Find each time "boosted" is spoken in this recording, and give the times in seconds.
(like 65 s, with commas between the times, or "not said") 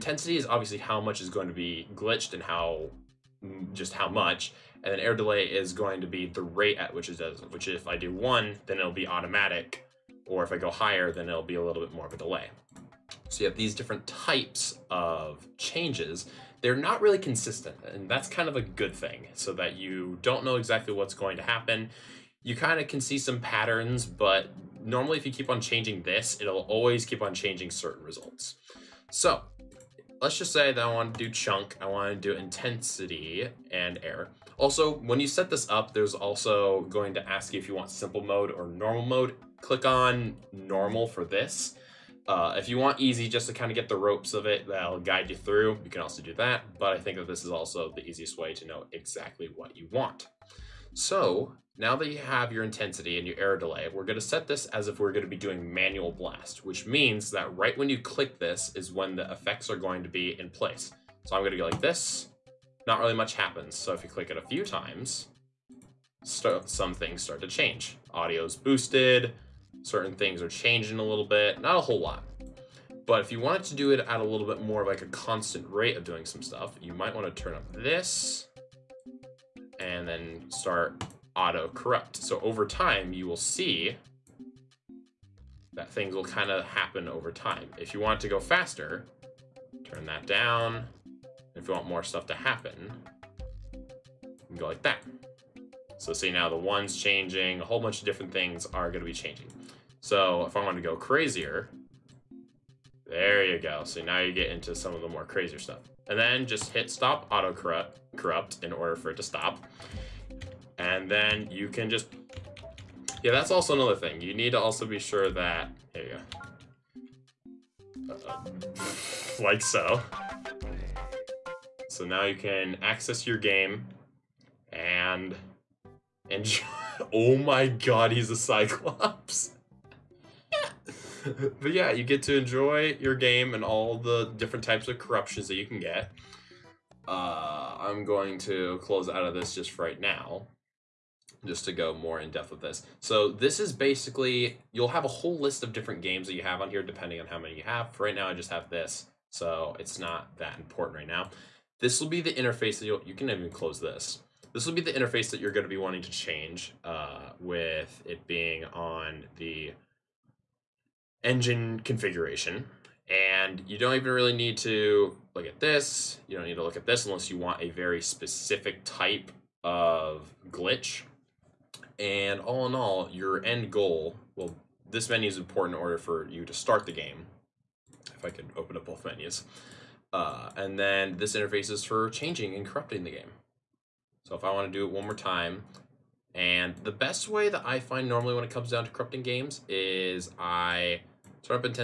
68 s.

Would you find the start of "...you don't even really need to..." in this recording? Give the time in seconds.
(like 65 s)
163 s.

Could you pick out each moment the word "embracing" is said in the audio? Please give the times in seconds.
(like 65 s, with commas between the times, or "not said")
not said.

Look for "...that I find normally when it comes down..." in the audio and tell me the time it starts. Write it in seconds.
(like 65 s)
187 s.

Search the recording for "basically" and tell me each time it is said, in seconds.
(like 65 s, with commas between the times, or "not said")
143 s.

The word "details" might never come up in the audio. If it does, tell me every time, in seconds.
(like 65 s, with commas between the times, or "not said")
not said.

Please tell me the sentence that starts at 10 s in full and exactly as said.
Or if I go higher, then it'll be a little bit more of a delay.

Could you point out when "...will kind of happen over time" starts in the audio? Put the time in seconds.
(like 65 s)
86 s.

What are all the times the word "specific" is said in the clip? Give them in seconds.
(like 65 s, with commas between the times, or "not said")
167 s.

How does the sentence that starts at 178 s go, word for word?
If I could open up both menus.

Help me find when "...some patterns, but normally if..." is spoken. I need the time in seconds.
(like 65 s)
23 s.